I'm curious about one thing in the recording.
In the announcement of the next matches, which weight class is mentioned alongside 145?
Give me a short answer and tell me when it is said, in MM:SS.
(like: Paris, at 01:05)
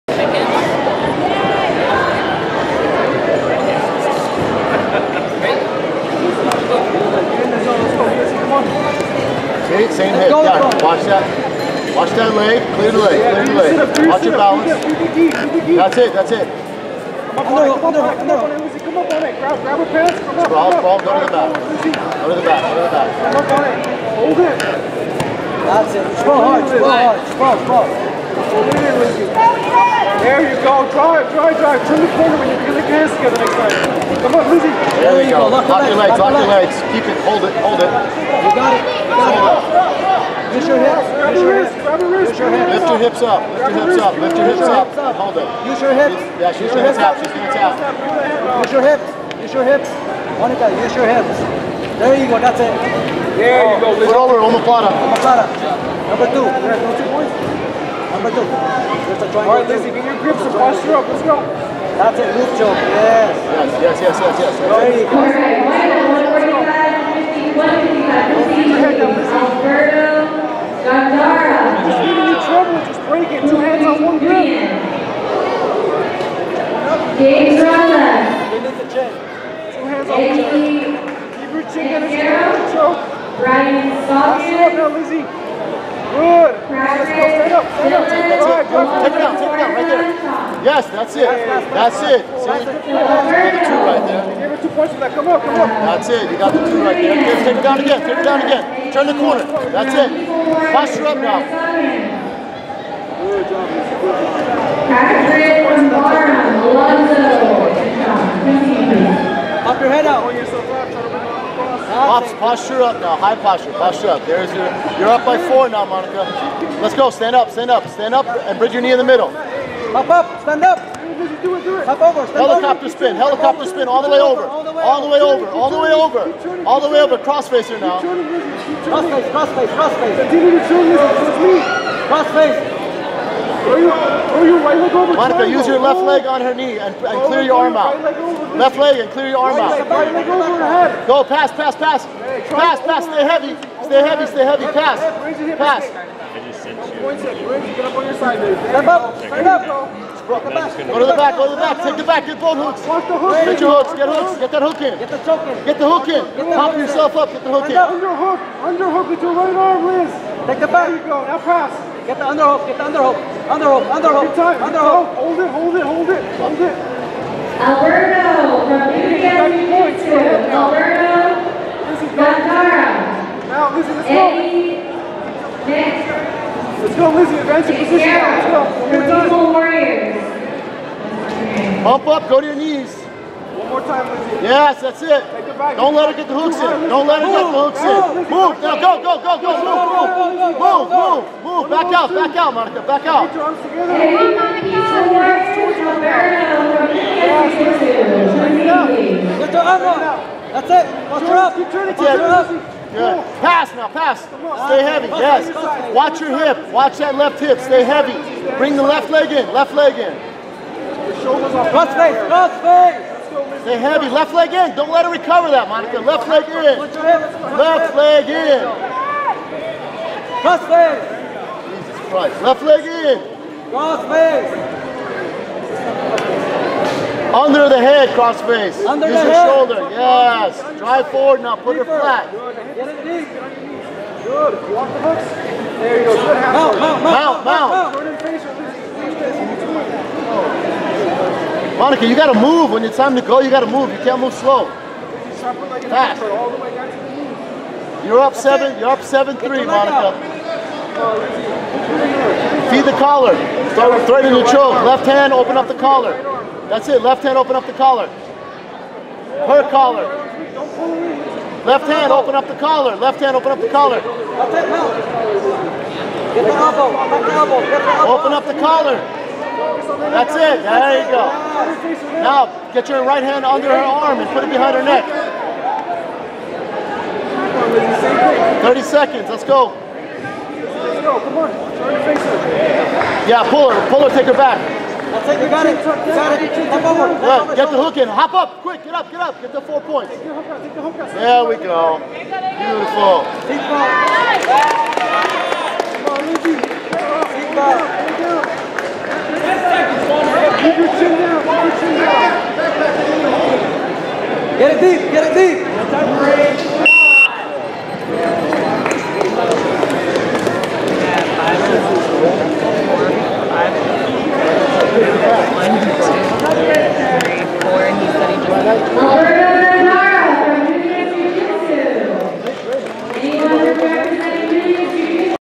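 155, at 01:07.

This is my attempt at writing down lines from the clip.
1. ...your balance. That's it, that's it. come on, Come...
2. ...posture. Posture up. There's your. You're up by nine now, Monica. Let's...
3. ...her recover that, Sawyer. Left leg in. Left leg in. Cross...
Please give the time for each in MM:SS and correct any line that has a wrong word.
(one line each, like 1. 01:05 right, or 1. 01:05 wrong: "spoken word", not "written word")
1. 00:14 right
2. 01:53 wrong: "four", not "nine"
3. 03:35 wrong: "Monica", not "Sawyer".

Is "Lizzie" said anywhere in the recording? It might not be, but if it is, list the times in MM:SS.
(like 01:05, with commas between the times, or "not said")
00:34, 00:53, 00:59, 01:24, 03:04.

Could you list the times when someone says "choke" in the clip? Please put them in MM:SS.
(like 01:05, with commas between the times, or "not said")
02:35, 04:14.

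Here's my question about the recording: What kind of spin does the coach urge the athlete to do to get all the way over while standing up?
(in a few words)
Helicopter spin.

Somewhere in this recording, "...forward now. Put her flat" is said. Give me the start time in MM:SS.
03:51.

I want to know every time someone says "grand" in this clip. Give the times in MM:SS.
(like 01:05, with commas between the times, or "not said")
not said.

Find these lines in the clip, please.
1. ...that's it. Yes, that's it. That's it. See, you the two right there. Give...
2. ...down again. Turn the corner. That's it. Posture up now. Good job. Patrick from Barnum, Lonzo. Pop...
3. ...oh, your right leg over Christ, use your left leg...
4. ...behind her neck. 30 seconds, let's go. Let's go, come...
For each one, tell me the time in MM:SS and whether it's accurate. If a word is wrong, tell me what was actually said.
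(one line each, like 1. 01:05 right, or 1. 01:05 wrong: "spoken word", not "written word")
1. 01:30 right
2. 01:38 right
3. 02:14 wrong: "Monica", not "Christ"
4. 04:34 right.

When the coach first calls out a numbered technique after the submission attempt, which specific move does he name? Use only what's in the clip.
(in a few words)
Omoplata.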